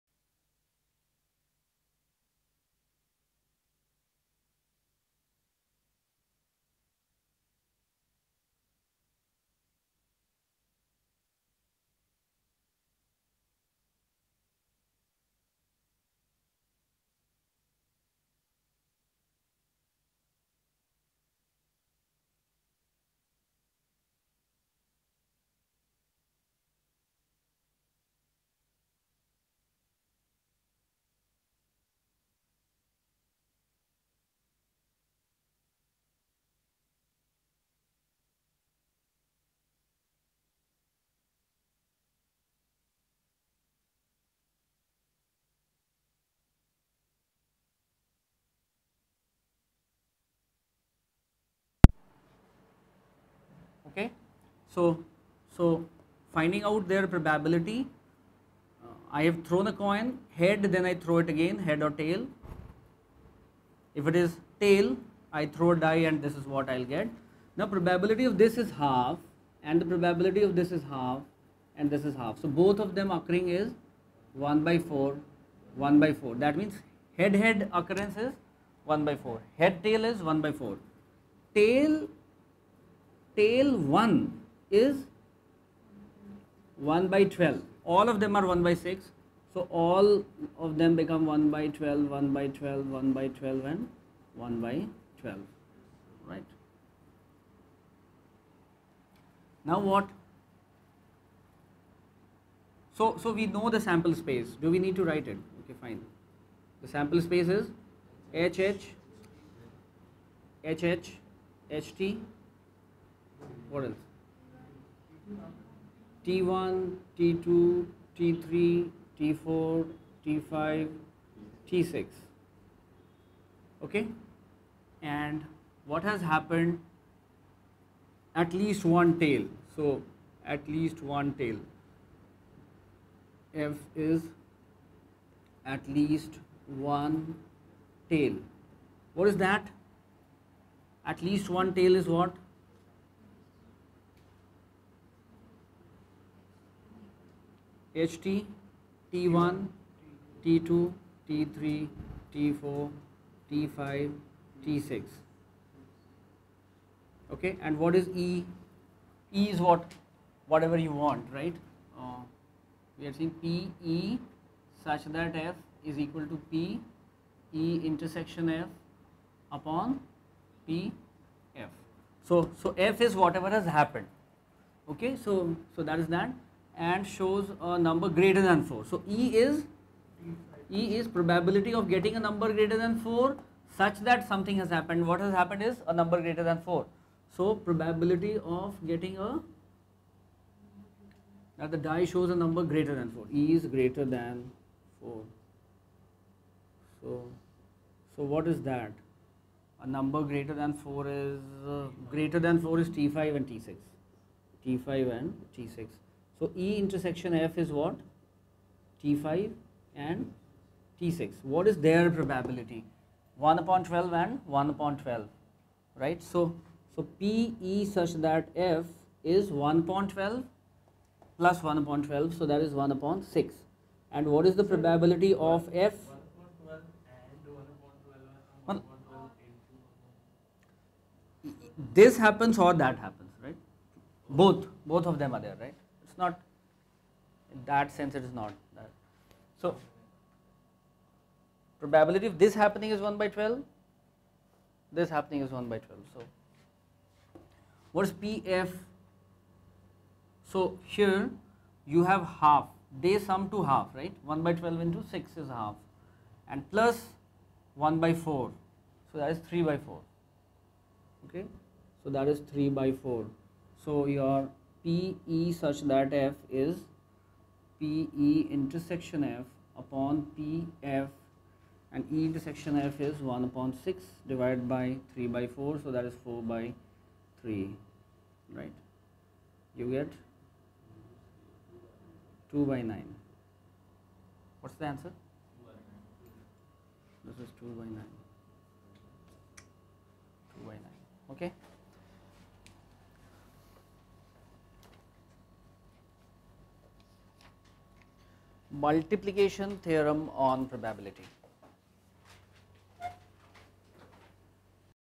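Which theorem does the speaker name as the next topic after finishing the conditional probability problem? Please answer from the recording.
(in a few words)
multiplication theorem.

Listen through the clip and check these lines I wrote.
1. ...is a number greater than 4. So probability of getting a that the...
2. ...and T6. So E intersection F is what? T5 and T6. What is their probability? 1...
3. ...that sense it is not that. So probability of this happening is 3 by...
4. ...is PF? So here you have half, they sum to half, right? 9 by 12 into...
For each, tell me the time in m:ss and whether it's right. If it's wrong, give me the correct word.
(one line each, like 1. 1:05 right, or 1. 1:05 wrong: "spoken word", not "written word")
1. 3:05 right
2. 3:25 right
3. 3:57 wrong: "1", not "3"
4. 4:08 wrong: "1", not "9".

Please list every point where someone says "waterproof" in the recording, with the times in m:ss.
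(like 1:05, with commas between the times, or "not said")
not said.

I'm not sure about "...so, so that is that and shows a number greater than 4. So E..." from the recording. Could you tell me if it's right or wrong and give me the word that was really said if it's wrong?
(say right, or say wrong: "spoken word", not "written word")
right.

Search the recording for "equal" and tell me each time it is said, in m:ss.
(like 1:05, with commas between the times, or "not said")
2:45.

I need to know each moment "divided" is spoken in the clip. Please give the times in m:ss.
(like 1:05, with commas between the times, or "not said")
4:34.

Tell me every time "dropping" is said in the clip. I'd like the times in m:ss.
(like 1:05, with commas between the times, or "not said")
not said.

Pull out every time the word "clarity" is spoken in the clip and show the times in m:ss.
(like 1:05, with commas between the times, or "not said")
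not said.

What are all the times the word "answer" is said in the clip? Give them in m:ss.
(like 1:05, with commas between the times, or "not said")
4:44.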